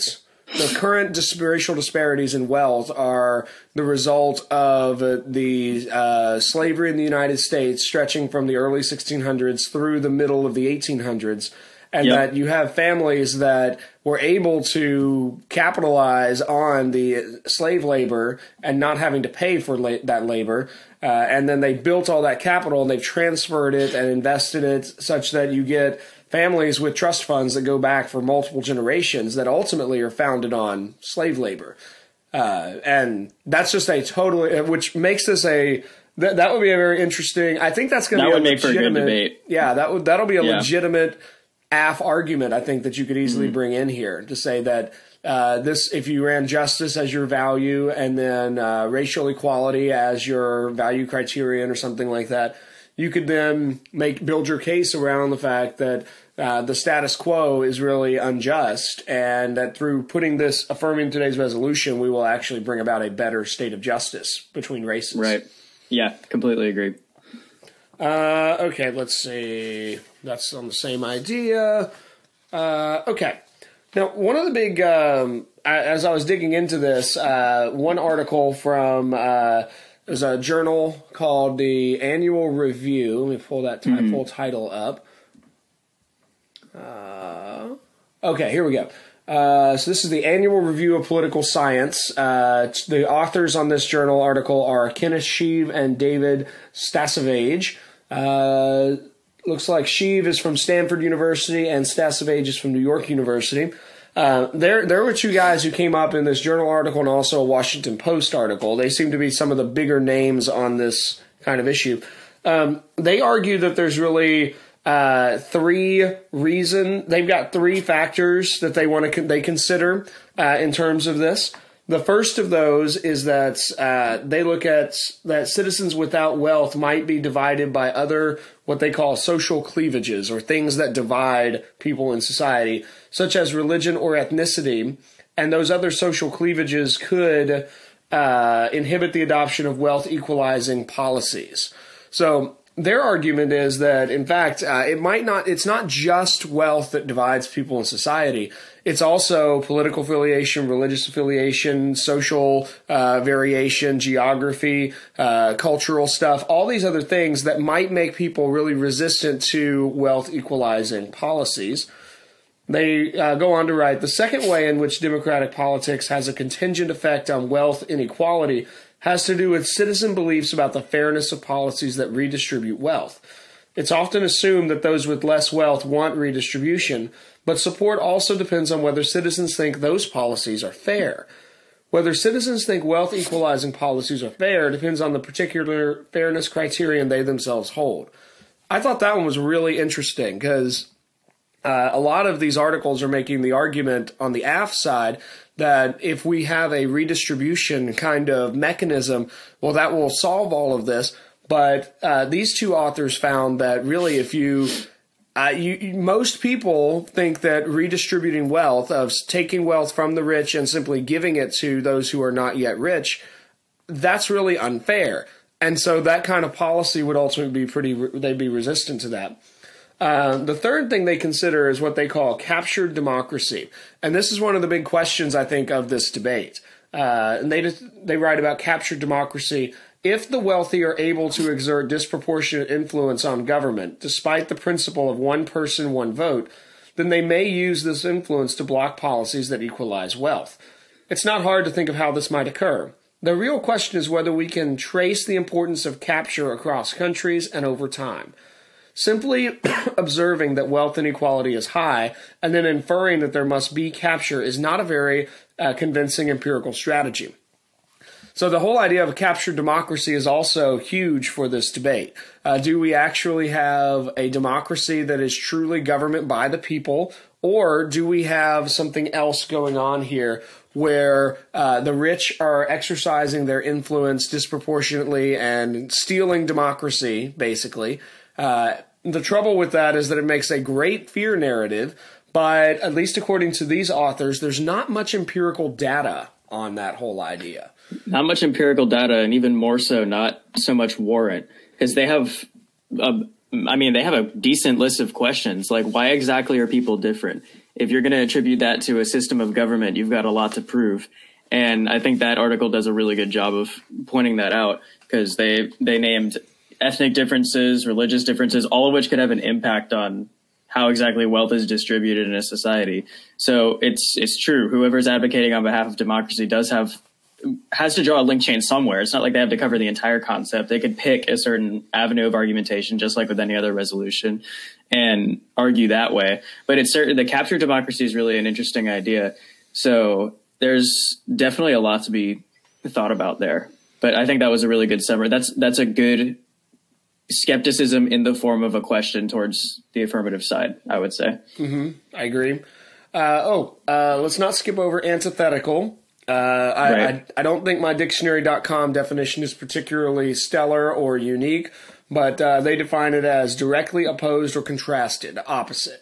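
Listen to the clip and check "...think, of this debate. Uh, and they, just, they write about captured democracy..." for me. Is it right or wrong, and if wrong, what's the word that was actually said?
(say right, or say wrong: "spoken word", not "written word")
right.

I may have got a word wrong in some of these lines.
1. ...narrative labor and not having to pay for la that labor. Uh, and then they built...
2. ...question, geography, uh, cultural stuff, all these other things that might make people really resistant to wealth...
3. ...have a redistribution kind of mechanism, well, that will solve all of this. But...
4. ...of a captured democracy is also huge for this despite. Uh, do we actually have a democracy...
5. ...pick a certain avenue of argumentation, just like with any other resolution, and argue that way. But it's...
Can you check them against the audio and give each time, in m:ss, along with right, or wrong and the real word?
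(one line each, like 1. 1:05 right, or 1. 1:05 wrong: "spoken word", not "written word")
1. 0:17 wrong: "slave", not "narrative"
2. 2:33 wrong: "variation", not "question"
3. 3:16 right
4. 4:19 wrong: "debate", not "despite"
5. 5:20 right.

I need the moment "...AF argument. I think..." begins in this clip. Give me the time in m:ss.
0:41.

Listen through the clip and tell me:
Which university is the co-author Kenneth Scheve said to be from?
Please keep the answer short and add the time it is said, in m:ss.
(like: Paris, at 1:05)
Stanford University, at 1:40.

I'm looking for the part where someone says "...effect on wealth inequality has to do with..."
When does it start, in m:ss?
2:46.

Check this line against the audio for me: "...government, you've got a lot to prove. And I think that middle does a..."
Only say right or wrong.
wrong.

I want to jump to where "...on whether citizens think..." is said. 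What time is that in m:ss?
2:58.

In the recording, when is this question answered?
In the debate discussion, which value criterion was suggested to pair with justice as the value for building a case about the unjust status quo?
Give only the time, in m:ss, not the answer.
0:48.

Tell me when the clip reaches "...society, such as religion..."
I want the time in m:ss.
2:12.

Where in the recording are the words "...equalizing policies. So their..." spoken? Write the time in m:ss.
2:20.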